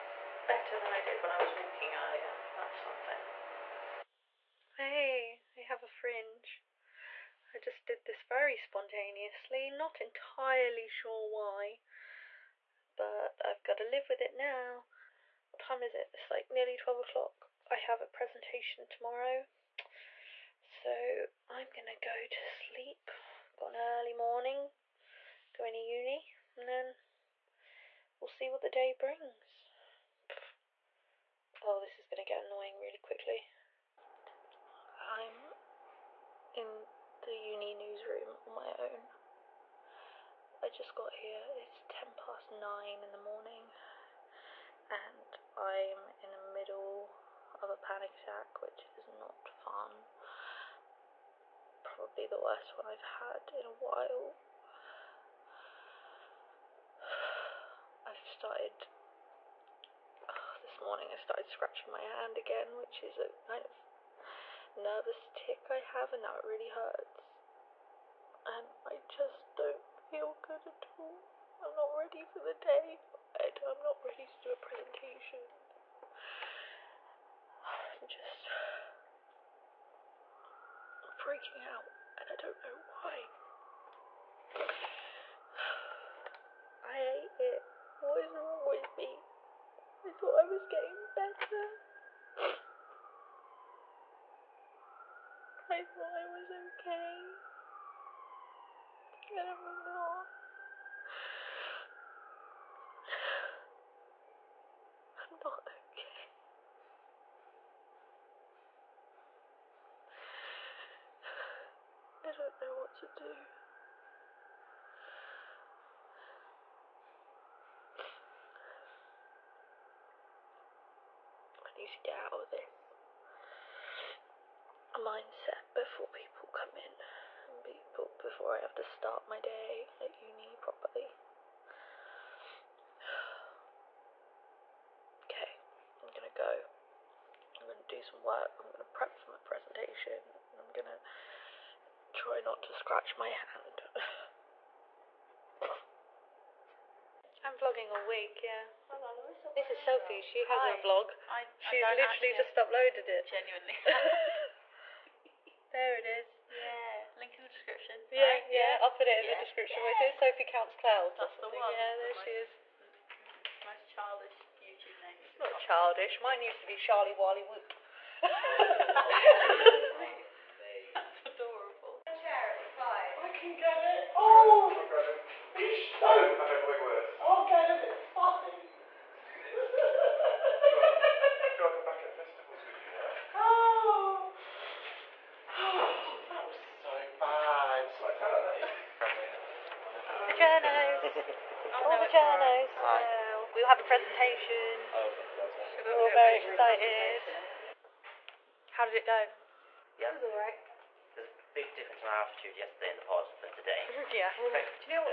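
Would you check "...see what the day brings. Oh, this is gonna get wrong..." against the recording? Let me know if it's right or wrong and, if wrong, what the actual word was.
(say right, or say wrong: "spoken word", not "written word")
wrong: "annoying", not "wrong".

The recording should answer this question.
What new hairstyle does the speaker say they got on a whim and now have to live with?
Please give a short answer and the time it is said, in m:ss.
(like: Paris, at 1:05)
A fringe, at 0:05.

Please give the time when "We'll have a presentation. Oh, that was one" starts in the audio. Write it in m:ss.
3:13.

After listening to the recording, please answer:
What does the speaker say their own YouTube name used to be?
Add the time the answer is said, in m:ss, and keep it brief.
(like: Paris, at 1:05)
Charlie Wally Whoop, at 2:46.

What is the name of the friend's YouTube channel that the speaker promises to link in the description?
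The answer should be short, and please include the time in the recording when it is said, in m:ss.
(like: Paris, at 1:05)
Sophie Counts Clouds, at 2:40.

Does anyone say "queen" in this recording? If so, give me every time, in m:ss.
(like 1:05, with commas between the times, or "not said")
not said.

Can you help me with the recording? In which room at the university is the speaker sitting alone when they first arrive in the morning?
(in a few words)
The uni newsroom.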